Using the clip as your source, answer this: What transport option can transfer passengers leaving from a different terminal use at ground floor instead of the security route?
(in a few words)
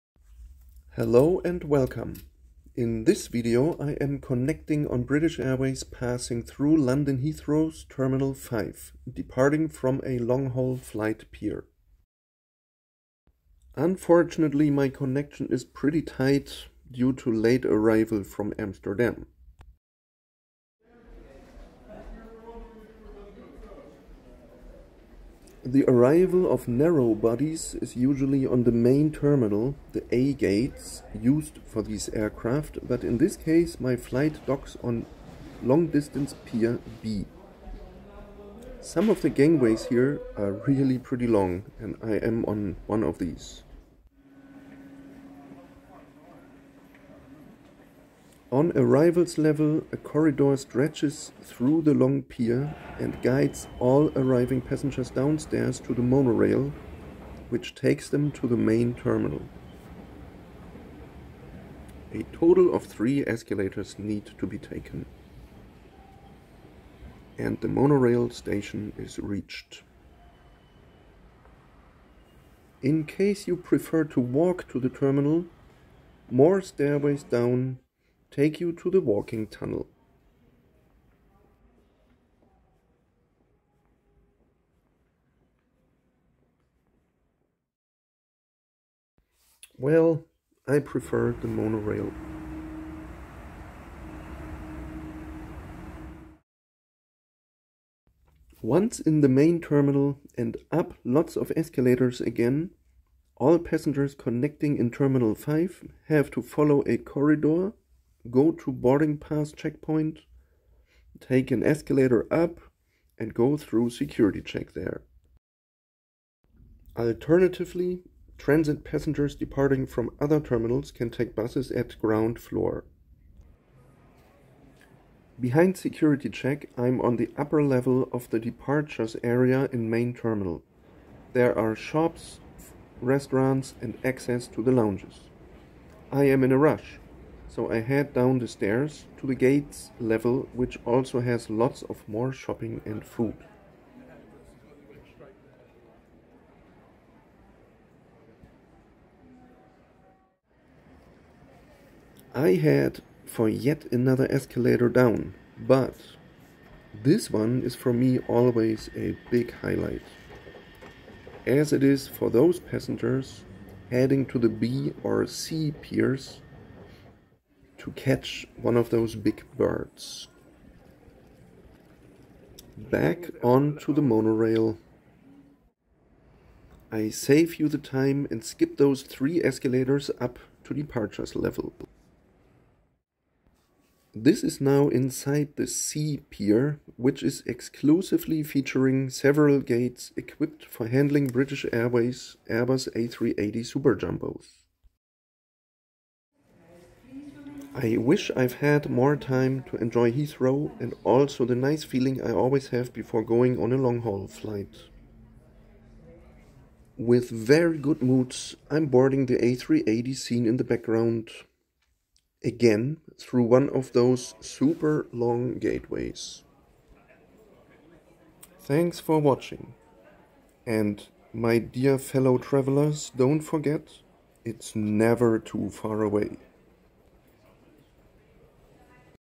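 Buses.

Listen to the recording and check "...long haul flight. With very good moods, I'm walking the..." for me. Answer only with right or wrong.
wrong.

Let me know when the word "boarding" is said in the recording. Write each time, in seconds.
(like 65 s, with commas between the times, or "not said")
108 s, 208 s.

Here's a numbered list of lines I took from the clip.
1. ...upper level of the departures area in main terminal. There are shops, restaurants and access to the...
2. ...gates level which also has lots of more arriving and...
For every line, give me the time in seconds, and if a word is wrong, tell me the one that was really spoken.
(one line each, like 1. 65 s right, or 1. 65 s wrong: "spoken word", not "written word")
1. 127 s right
2. 139 s wrong: "shopping", not "arriving".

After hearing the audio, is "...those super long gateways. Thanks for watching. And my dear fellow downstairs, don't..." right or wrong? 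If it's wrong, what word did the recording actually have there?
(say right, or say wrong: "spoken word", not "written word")
wrong: "travelers", not "downstairs".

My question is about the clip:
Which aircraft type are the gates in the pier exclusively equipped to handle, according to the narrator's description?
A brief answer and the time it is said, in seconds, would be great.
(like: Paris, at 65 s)
Airbus A380, at 192 s.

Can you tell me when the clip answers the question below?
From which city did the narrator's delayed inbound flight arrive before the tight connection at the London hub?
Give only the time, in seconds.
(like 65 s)
18 s.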